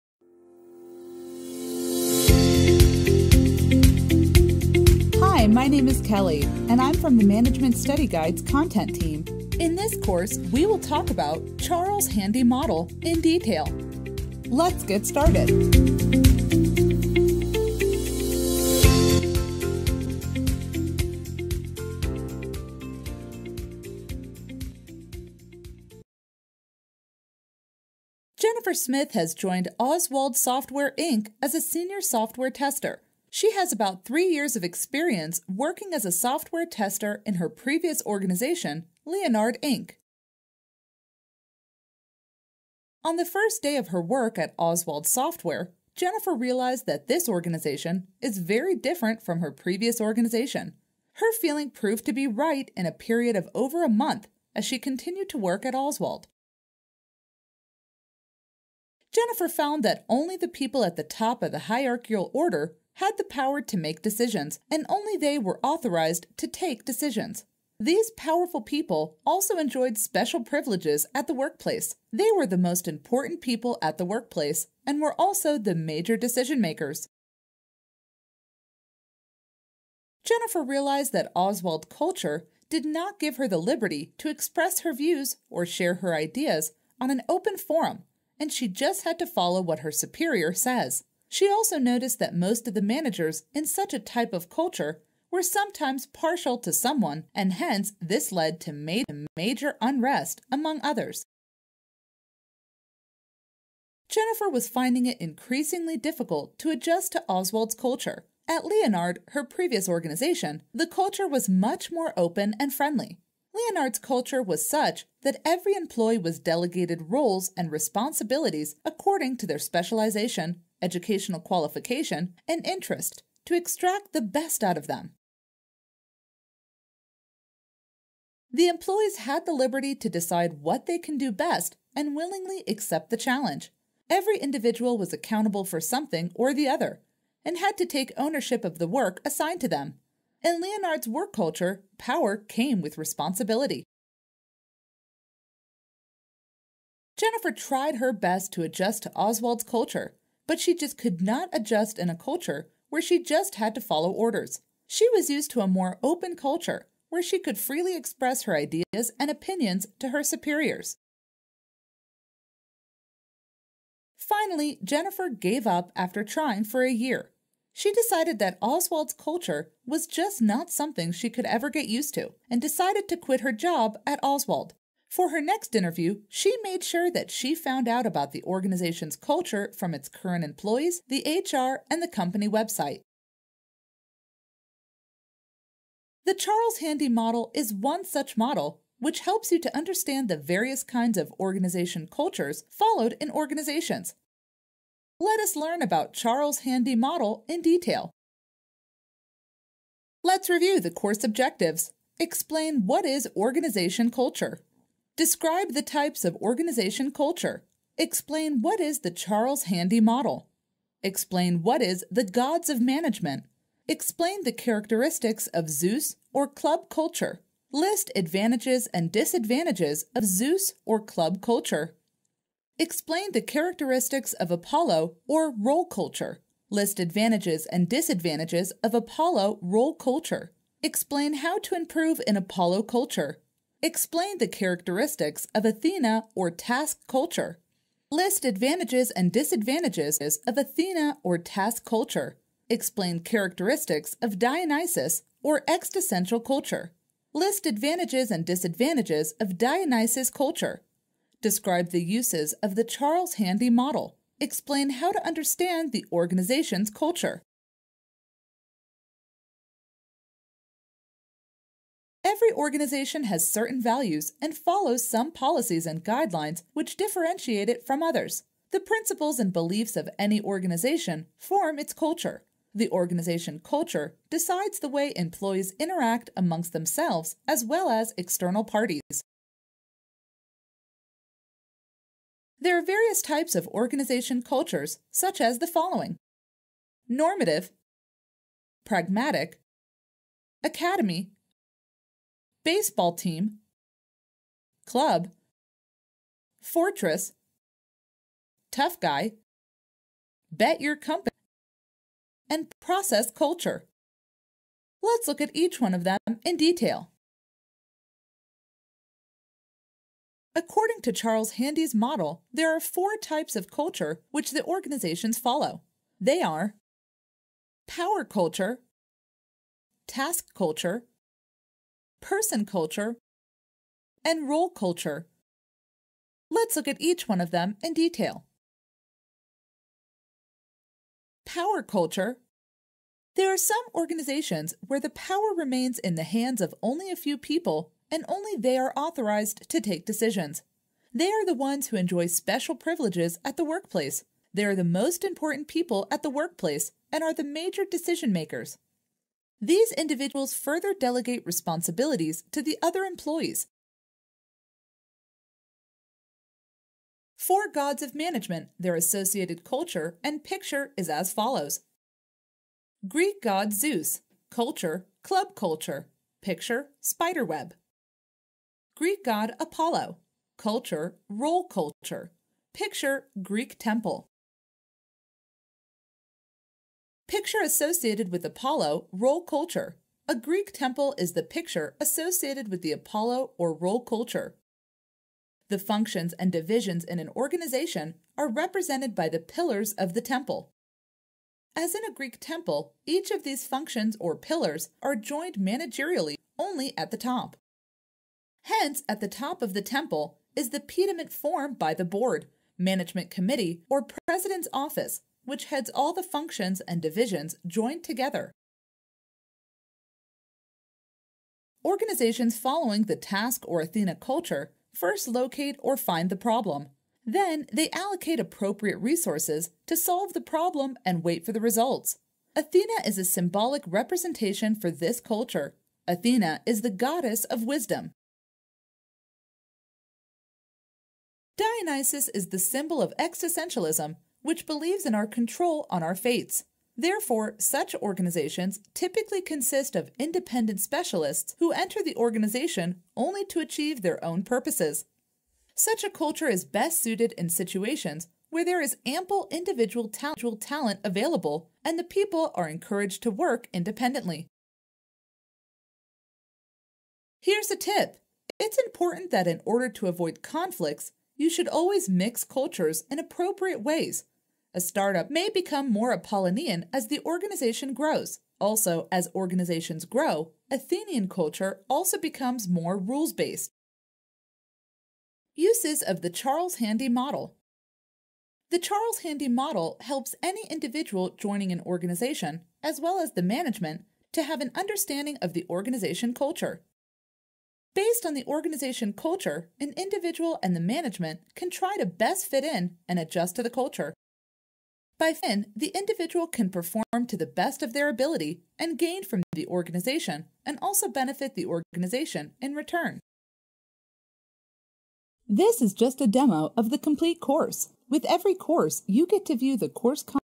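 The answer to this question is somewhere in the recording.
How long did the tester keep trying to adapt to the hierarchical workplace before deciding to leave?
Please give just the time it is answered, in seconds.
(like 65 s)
166 s.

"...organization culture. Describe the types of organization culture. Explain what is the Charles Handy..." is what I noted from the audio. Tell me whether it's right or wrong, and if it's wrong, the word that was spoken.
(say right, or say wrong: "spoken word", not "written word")
right.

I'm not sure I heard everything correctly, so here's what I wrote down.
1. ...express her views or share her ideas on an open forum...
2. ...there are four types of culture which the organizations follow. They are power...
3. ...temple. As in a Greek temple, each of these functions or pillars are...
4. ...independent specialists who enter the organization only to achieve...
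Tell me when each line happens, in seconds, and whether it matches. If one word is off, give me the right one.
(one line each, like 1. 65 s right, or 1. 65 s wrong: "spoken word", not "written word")
1. 84 s right
2. 312 s right
3. 390 s right
4. 440 s right.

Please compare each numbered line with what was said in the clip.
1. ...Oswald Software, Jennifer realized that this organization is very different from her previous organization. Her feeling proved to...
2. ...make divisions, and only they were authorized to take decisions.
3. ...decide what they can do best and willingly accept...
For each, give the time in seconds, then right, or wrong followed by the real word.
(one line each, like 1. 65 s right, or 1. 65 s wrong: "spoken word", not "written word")
1. 44 s right
2. 63 s wrong: "decisions", not "divisions"
3. 130 s right.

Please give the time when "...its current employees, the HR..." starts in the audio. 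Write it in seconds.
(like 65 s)
179 s.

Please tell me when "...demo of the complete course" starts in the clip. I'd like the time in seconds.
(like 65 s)
506 s.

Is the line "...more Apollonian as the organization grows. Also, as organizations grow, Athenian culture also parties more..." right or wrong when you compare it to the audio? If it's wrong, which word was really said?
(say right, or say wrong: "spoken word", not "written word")
wrong: "becomes", not "parties".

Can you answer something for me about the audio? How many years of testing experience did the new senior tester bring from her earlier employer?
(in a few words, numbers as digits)
3.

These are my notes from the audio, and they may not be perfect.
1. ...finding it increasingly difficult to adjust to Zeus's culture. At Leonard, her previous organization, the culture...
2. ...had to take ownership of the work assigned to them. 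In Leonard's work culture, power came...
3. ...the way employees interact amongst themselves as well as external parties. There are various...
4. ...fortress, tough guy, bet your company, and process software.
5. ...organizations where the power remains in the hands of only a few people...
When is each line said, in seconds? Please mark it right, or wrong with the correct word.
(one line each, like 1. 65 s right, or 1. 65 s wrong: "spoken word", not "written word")
1. 104 s wrong: "Oswald", not "Zeus"
2. 137 s right
3. 274 s right
4. 296 s wrong: "culture", not "software"
5. 333 s right.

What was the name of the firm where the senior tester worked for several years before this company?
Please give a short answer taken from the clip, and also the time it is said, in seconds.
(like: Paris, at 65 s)
Leonard Inc., at 39 s.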